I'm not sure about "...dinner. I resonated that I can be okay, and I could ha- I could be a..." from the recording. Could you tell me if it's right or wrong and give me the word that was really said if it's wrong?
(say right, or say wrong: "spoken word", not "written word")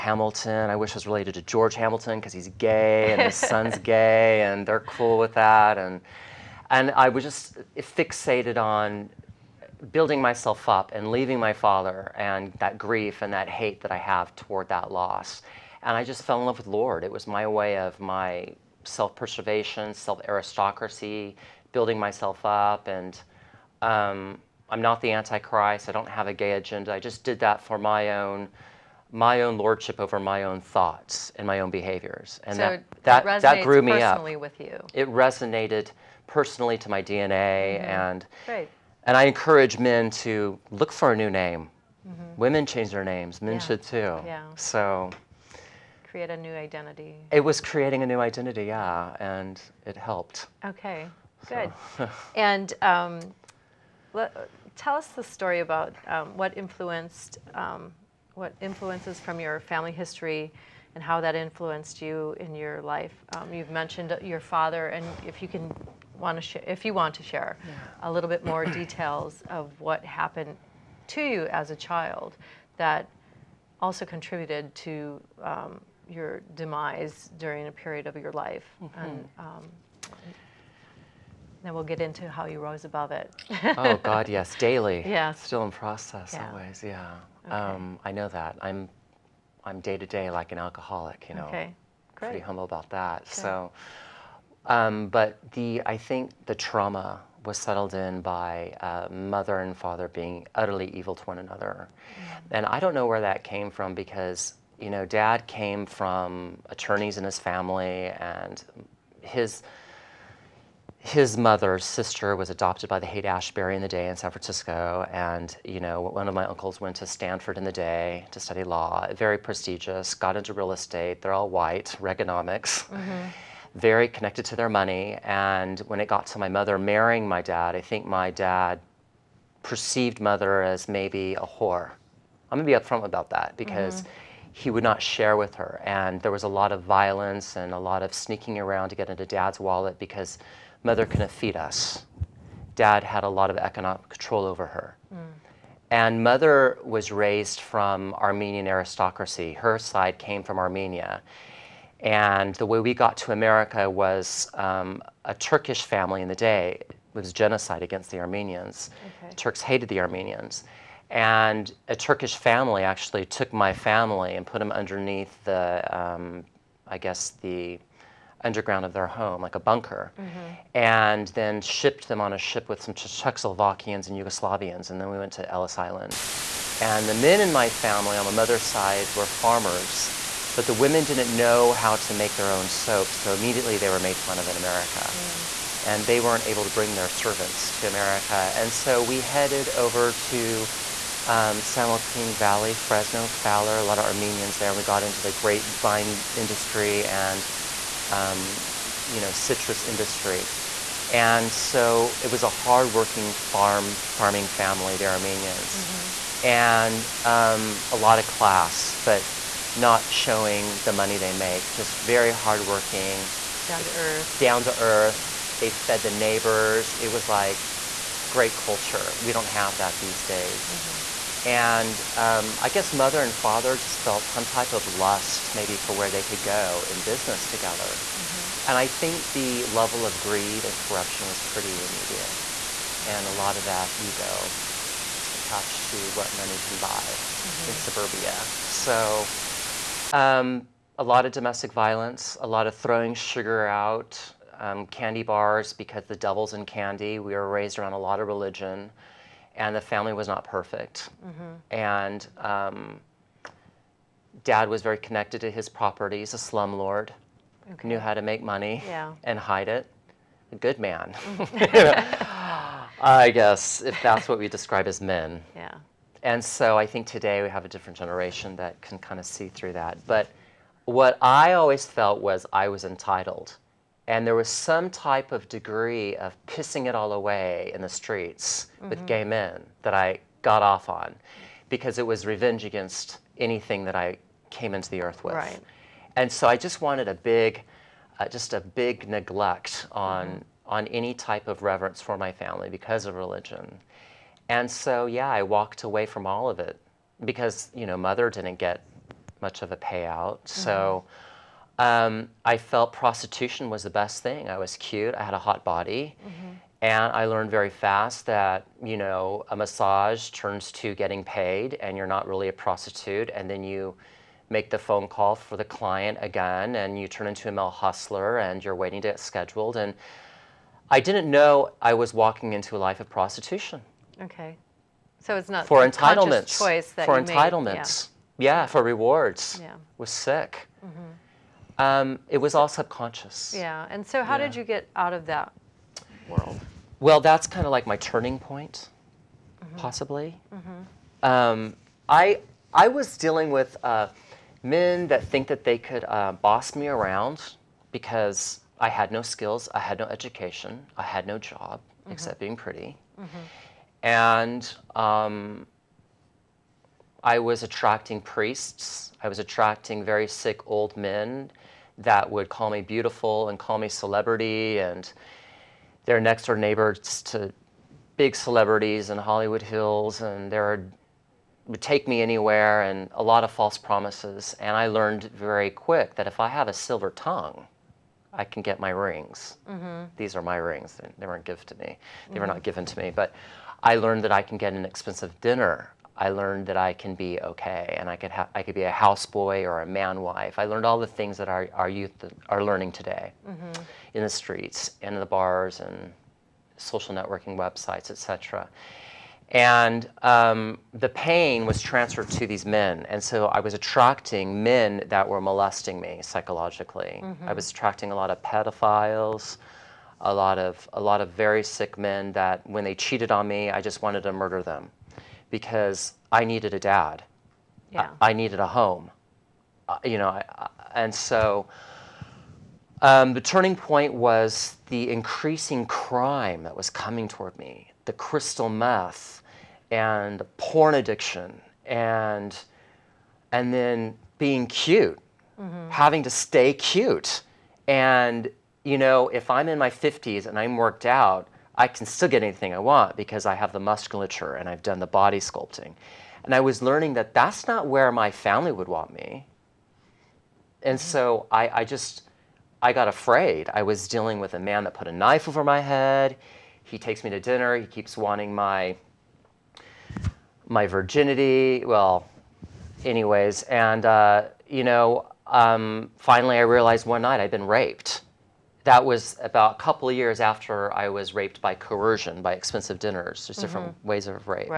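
wrong: "learned", not "resonated".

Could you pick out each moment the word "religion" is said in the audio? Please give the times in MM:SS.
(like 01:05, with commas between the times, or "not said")
04:08, 04:53.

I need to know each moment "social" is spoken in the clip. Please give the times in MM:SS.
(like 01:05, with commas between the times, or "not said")
06:36.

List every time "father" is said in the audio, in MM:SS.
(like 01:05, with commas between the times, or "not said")
00:11, 01:04, 01:39, 03:43.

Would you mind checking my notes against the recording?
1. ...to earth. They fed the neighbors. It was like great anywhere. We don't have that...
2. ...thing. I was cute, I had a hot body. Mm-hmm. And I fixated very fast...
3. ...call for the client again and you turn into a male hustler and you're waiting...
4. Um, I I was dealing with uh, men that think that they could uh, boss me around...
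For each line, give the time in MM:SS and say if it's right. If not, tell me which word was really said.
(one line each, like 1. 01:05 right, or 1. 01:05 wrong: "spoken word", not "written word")
1. 03:34 wrong: "culture", not "anywhere"
2. 05:04 wrong: "learned", not "fixated"
3. 05:15 right
4. 05:41 right.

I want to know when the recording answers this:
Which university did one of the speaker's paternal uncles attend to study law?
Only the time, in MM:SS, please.
01:57.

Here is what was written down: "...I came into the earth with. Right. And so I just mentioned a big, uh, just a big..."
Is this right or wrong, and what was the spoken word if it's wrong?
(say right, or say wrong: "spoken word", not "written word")
wrong: "wanted", not "mentioned".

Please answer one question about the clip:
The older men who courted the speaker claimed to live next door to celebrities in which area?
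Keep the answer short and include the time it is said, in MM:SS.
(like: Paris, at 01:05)
Hollywood Hills, at 06:09.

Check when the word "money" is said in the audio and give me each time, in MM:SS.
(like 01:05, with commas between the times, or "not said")
02:04, 03:30, 03:56, 04:18.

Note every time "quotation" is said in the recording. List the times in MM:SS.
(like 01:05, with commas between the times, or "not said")
not said.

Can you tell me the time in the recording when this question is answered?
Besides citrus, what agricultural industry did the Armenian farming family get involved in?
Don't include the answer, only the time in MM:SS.
03:15.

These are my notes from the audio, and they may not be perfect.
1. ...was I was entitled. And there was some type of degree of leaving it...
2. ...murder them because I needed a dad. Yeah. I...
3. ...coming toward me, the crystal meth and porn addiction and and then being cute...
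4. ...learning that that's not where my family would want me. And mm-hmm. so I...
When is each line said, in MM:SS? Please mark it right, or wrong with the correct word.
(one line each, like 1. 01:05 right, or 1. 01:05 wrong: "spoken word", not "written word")
1. 04:32 wrong: "pissing", not "leaving"
2. 06:54 right
3. 07:06 right
4. 07:26 right.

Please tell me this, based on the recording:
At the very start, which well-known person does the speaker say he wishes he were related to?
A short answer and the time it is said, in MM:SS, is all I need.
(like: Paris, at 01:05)
George Hamilton, at 00:01.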